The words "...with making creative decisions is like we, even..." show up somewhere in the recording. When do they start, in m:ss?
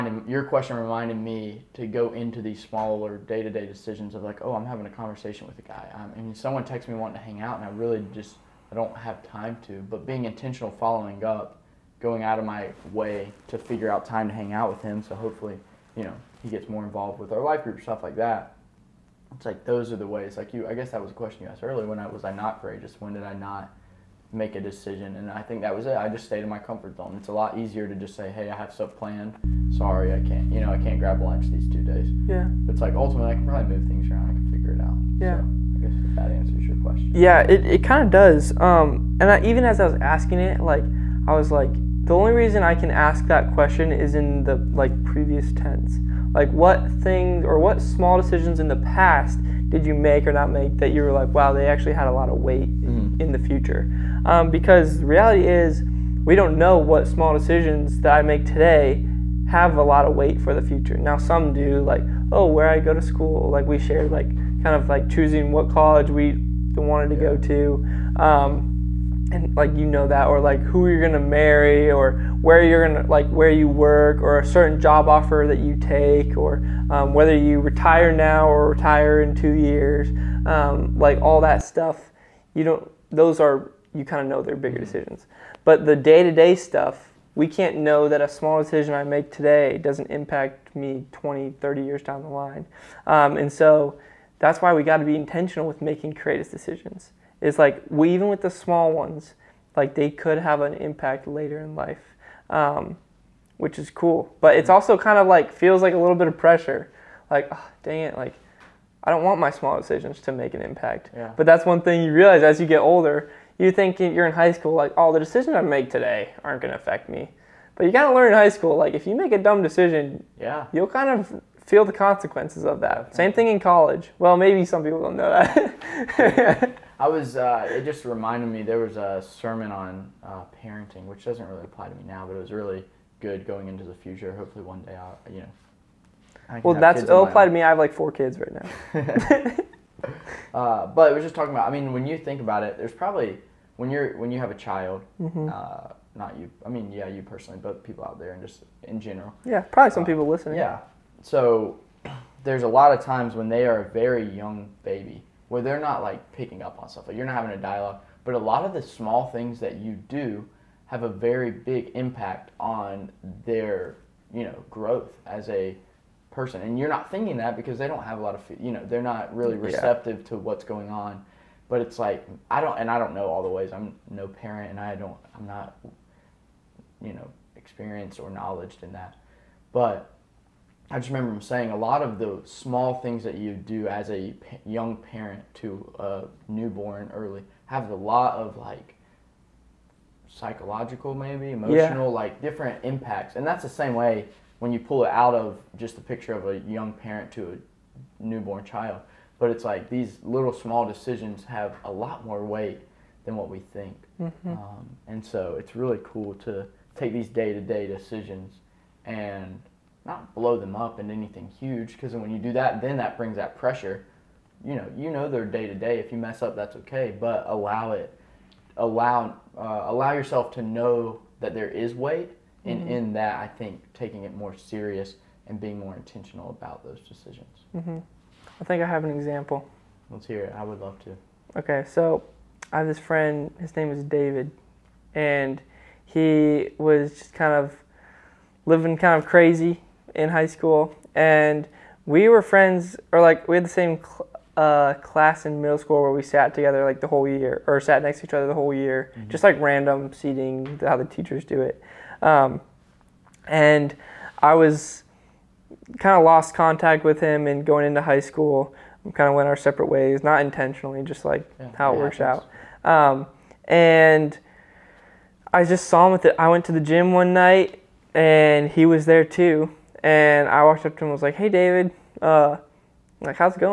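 1:35.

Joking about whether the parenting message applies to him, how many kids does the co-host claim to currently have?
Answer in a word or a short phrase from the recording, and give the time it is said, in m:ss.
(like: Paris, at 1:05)
4, at 2:17.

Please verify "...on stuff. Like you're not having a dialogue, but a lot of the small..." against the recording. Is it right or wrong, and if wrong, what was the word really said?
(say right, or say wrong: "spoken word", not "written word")
right.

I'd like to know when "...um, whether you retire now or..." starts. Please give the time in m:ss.
1:16.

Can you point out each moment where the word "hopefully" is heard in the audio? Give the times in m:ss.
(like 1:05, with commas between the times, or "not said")
0:15, 2:14.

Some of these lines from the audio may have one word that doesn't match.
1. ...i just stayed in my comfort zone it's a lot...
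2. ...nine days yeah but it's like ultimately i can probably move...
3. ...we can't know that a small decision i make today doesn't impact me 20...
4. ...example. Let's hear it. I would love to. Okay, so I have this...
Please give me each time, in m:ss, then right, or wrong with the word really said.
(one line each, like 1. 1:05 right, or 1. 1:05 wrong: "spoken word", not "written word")
1. 0:25 right
2. 0:31 wrong: "two", not "nine"
3. 1:27 right
4. 3:49 right.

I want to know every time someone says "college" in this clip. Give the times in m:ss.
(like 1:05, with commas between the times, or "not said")
1:05, 2:03.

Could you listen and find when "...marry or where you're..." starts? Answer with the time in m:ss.
1:11.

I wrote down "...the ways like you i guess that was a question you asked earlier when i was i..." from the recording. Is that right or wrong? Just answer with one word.
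right.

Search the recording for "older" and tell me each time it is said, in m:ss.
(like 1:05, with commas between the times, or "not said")
1:52.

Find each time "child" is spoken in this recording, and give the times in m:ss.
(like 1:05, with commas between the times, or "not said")
2:24, 3:18.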